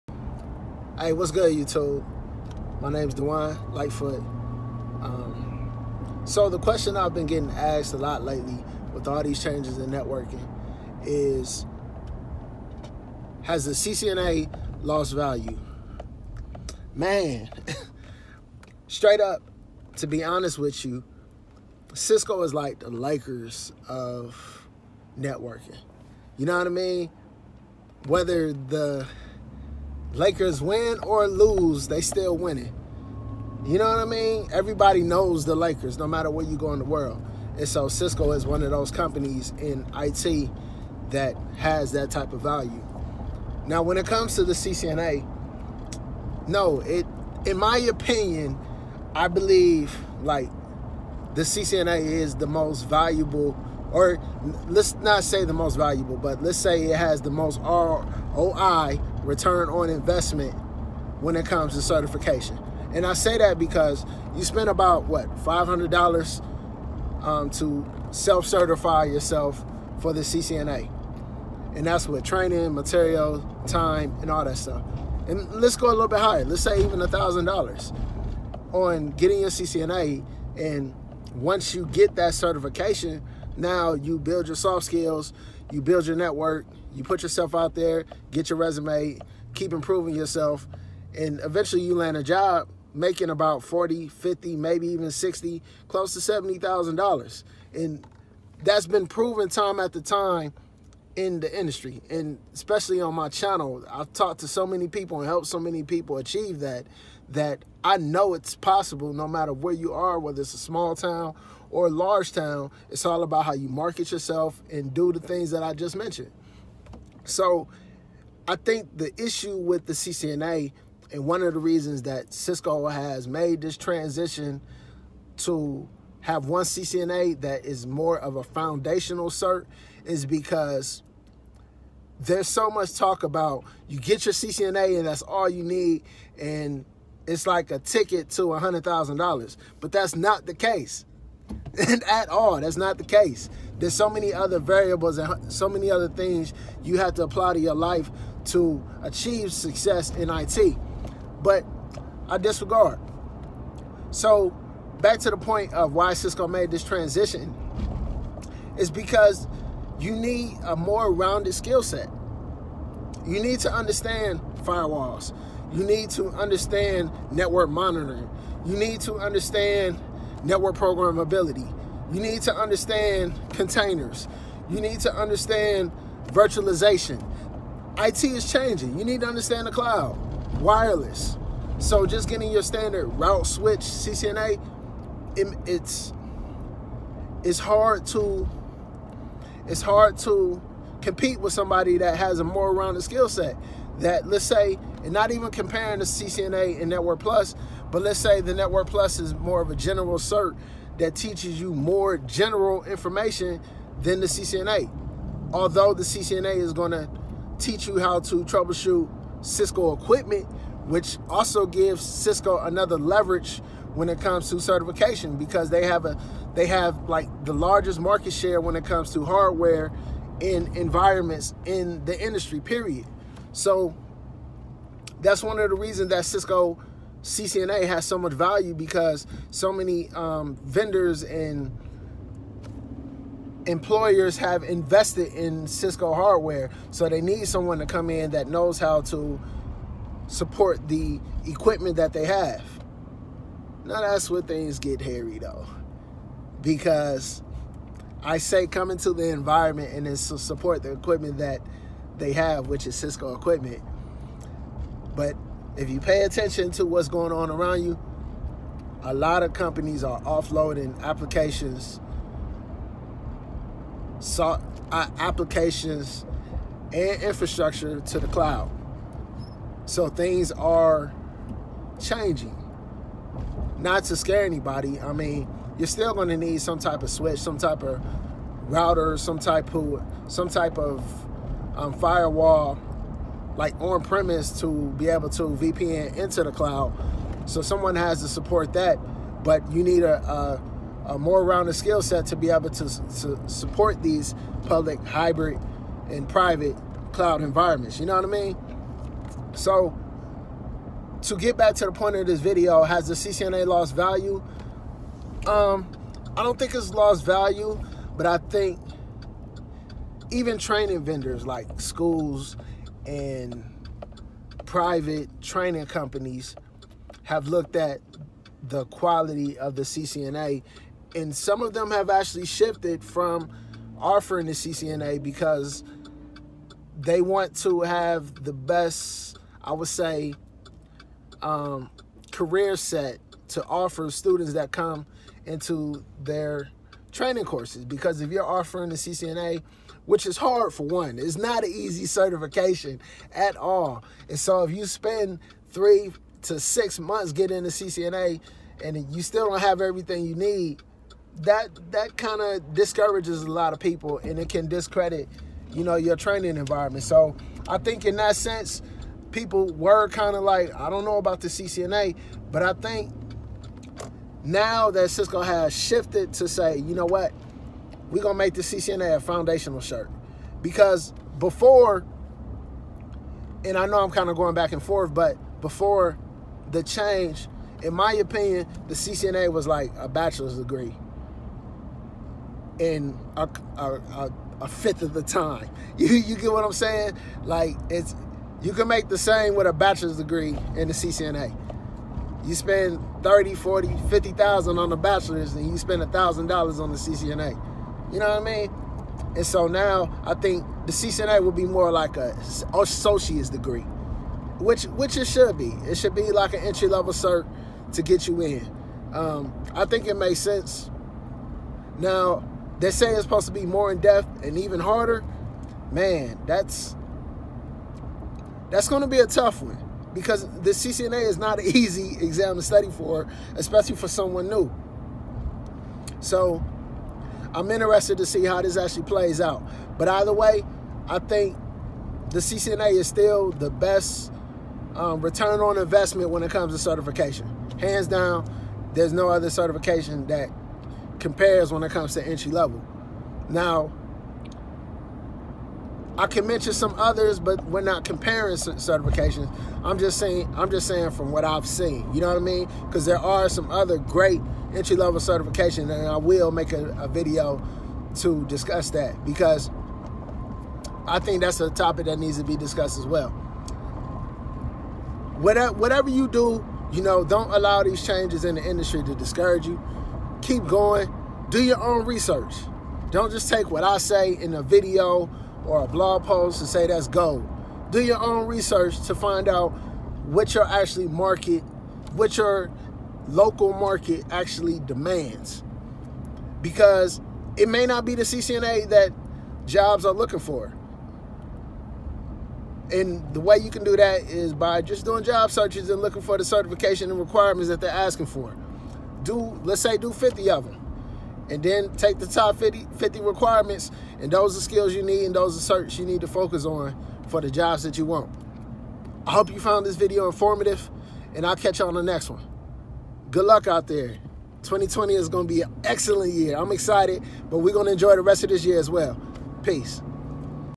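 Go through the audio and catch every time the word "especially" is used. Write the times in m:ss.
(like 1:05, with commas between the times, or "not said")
1:42, 7:03.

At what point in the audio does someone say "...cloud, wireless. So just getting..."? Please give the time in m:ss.
2:59.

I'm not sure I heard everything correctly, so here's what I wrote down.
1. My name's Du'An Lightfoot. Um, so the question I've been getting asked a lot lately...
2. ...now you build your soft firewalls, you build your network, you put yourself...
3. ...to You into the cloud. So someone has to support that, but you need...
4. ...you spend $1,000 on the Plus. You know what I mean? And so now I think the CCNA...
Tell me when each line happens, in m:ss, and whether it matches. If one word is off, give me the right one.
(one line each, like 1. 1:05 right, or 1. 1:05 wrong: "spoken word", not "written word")
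1. 0:02 right
2. 1:23 wrong: "skills", not "firewalls"
3. 4:45 wrong: "VPN", not "You"
4. 6:35 wrong: "CCNA", not "Plus".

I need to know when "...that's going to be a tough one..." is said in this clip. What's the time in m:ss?
6:58.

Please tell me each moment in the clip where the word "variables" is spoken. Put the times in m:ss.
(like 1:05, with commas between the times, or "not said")
2:24.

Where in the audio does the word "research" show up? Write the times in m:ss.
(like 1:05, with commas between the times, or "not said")
7:52, 7:58.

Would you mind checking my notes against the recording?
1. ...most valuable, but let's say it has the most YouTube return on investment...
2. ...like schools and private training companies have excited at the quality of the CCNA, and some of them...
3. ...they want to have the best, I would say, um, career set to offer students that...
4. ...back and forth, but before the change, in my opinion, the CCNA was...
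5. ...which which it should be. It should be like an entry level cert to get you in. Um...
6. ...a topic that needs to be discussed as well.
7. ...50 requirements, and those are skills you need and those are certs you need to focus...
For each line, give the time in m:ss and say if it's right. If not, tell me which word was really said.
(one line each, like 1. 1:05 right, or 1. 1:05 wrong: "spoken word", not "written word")
1. 0:55 wrong: "ROI", not "YouTube"
2. 5:11 wrong: "looked", not "excited"
3. 5:26 right
4. 6:14 right
5. 6:44 right
6. 7:41 right
7. 8:22 right.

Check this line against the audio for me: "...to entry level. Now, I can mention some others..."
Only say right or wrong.
right.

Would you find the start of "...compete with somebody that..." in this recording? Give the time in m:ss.
3:11.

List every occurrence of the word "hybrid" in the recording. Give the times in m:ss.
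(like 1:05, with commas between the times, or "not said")
4:55.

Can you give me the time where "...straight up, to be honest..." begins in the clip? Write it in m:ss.
0:18.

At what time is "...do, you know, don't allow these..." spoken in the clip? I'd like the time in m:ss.
7:46.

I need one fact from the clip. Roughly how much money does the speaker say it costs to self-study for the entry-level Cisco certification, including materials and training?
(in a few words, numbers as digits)
$500.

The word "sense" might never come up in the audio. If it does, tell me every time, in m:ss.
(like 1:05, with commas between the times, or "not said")
5:58, 6:50.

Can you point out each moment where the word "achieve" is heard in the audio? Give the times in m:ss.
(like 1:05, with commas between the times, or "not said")
1:46, 2:29.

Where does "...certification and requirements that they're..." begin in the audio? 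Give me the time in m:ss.
8:16.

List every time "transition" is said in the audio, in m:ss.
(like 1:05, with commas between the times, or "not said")
2:03, 2:36.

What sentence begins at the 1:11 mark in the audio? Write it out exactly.
And that's with training, material, time, and all that stuff.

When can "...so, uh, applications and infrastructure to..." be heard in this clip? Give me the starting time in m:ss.
4:24.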